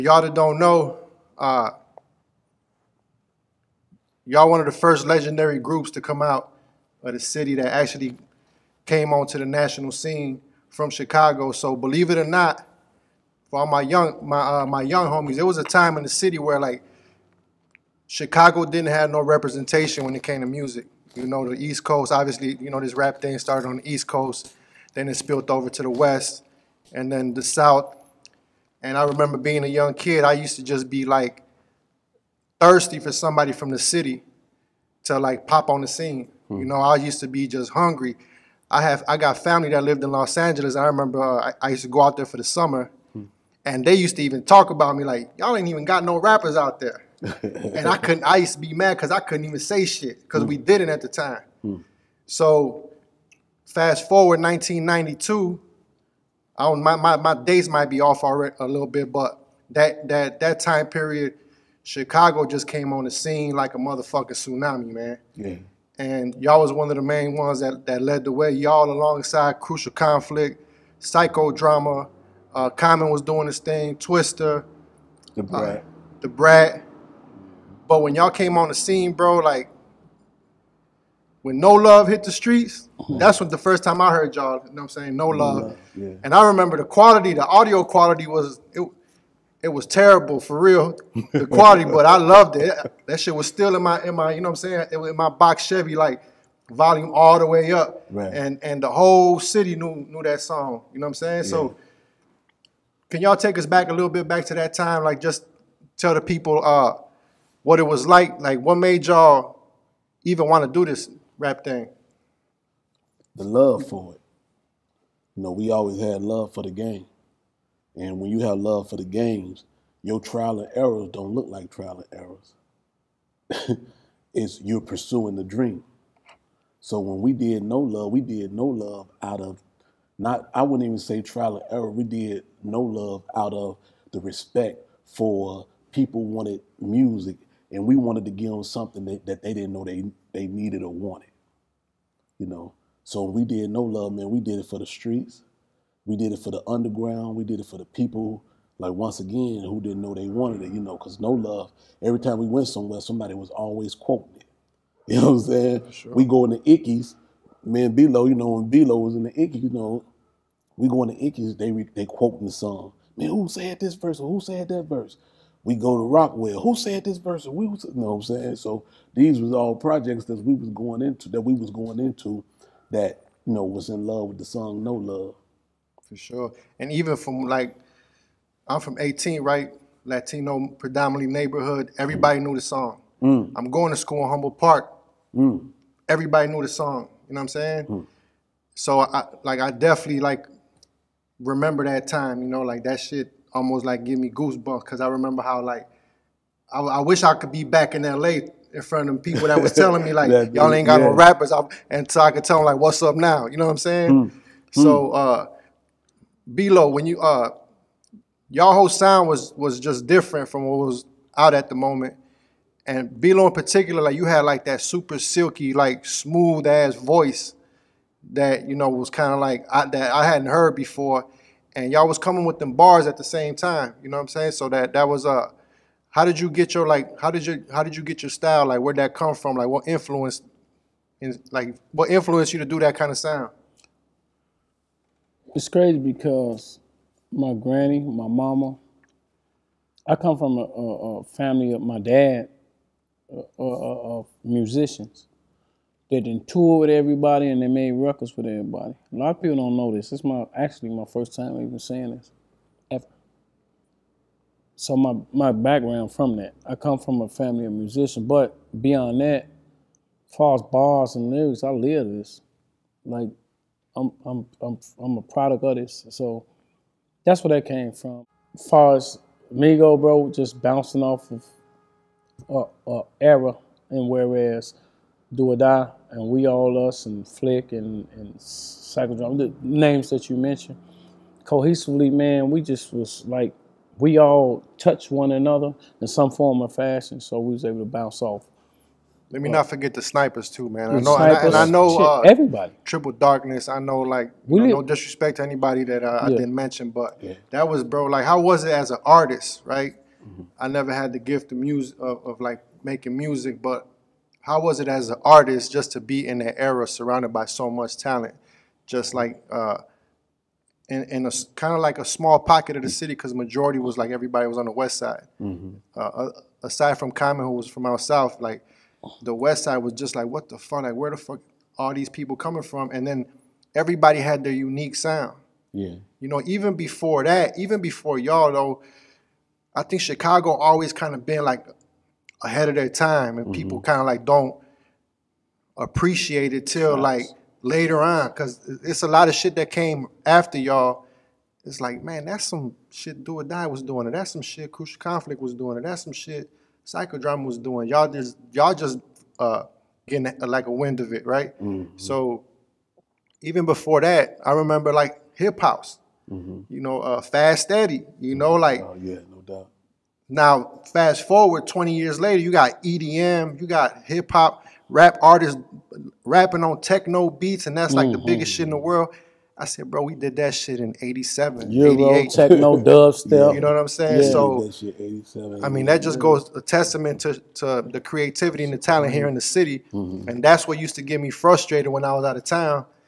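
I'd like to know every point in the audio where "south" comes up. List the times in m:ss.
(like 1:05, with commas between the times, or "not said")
0:27, 5:17.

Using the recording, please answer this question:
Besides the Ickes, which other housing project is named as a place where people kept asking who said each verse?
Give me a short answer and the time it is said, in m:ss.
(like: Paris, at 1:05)
Rockwell, at 2:46.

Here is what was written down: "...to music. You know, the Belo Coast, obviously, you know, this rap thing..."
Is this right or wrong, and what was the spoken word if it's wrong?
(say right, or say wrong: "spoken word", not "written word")
wrong: "East", not "Belo".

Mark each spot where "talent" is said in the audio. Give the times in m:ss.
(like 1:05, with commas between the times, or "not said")
5:07, 6:18.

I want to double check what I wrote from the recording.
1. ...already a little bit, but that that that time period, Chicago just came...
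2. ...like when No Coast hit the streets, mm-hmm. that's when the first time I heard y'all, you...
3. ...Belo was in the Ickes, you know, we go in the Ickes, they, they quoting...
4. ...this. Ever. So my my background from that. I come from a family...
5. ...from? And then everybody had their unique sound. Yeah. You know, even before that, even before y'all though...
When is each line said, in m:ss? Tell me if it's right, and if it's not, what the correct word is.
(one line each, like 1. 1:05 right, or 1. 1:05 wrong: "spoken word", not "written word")
1. 0:58 right
2. 1:19 wrong: "Love", not "Coast"
3. 2:38 right
4. 4:12 right
5. 5:22 right.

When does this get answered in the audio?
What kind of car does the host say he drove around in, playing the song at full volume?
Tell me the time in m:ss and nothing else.
1:35.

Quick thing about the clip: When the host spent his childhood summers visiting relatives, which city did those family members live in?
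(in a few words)
Los Angeles.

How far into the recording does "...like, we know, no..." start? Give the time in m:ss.
4:53.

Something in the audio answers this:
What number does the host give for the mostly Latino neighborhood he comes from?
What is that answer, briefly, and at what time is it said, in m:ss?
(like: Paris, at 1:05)
18, at 2:58.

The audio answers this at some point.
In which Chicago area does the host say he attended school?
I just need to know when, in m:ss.
3:04.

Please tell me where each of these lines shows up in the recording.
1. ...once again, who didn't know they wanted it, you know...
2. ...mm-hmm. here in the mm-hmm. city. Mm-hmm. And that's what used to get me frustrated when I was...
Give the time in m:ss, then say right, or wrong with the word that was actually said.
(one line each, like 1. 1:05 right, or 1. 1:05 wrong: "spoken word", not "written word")
1. 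2:28 right
2. 6:19 right.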